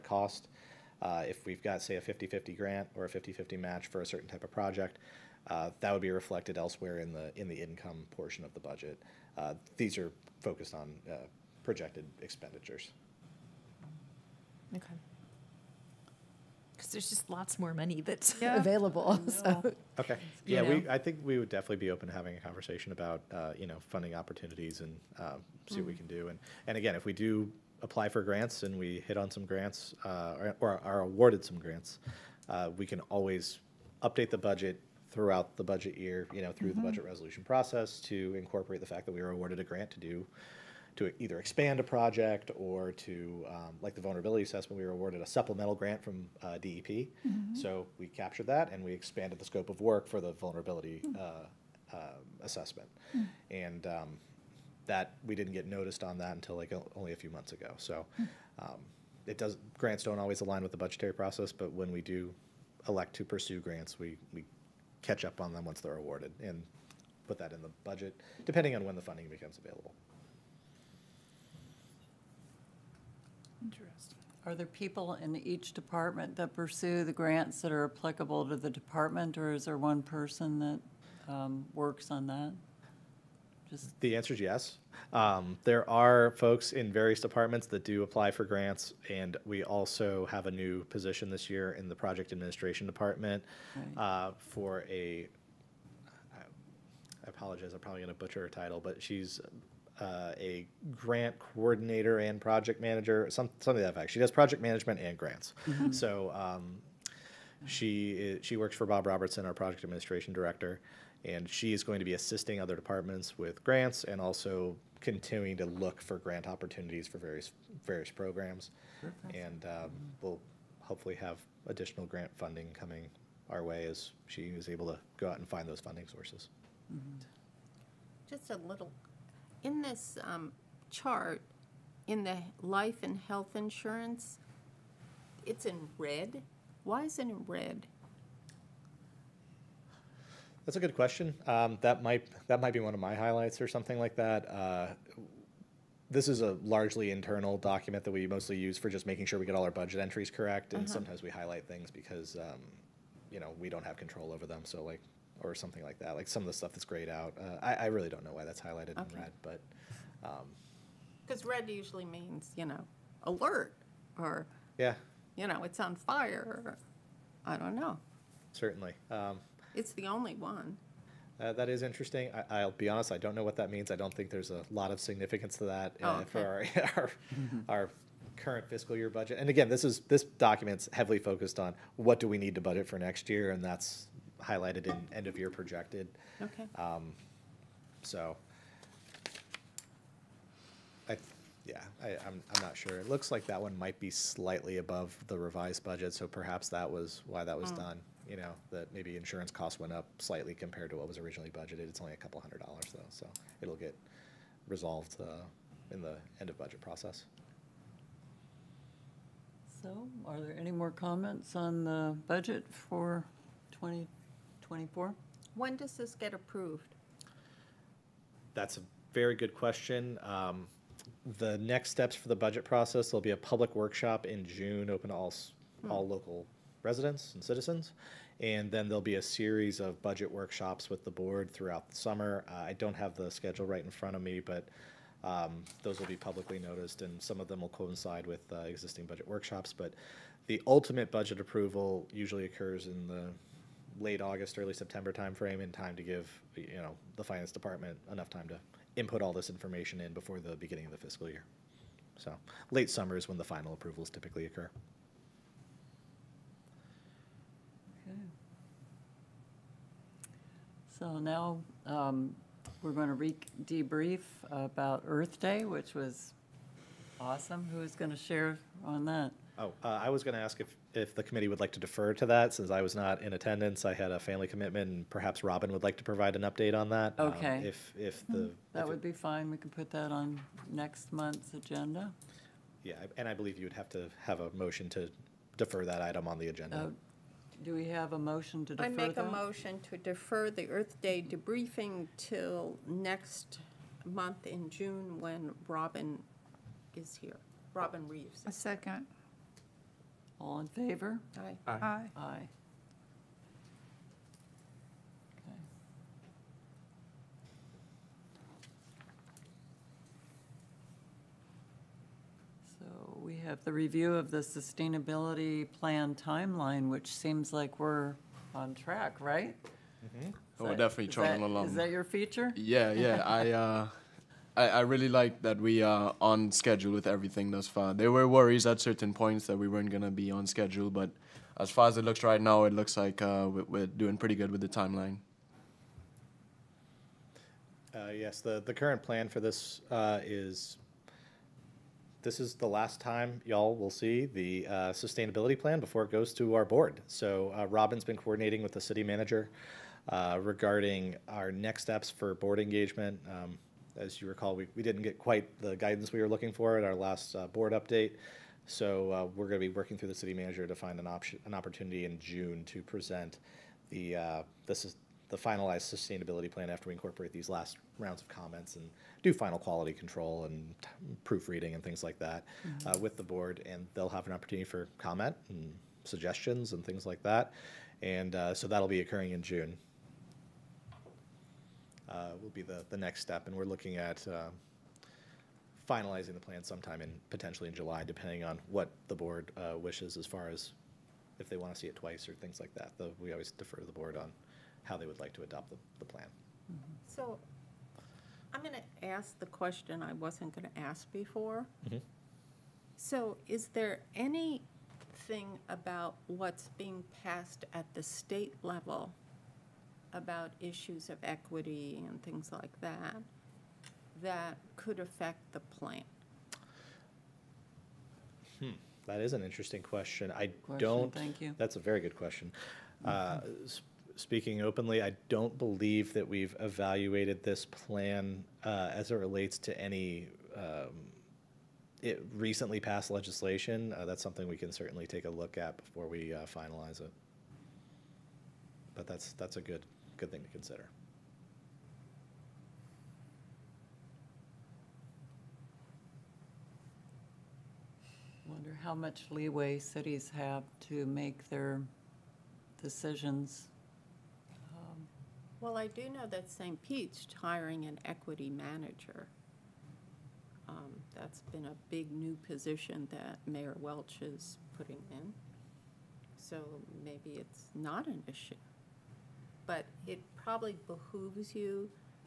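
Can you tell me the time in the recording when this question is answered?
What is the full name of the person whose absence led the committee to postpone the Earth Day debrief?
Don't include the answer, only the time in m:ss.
4:57.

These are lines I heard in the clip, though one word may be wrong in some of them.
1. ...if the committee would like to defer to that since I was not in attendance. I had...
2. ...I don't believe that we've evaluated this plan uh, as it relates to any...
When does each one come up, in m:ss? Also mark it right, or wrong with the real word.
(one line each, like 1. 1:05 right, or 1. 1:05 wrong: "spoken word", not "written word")
1. 4:30 right
2. 7:05 right.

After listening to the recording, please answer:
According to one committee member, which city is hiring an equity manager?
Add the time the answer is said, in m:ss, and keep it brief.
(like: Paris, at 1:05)
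St. Pete, at 7:36.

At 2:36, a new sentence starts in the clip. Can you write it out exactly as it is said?
Like some of the stuff that's grayed out.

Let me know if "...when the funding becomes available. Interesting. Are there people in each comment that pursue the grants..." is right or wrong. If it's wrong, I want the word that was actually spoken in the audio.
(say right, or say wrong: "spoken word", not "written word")
wrong: "department", not "comment".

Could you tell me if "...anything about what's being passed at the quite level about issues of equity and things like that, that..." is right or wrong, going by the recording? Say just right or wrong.
wrong.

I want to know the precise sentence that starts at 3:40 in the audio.
Um, the next steps for the budget process, there'll be a public workshop in June, open to all, hmm.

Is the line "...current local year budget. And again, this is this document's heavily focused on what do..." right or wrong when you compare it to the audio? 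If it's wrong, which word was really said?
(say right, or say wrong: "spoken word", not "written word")
wrong: "fiscal", not "local".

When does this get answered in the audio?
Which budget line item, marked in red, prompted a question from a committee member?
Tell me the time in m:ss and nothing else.
2:12.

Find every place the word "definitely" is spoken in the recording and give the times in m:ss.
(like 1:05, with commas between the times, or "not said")
0:21, 5:20.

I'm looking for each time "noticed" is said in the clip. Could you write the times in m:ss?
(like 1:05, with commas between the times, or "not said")
0:55, 3:56.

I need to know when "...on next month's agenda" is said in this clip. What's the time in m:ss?
4:40.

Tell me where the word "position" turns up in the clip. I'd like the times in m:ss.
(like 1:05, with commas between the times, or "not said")
1:30, 7:42.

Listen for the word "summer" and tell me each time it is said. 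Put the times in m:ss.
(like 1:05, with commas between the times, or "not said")
3:51, 4:12.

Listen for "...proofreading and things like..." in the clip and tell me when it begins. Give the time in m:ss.
6:11.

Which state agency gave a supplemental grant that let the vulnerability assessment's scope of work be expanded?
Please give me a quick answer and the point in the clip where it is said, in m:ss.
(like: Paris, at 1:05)
DEP, at 0:46.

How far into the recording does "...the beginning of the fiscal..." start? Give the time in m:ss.
4:10.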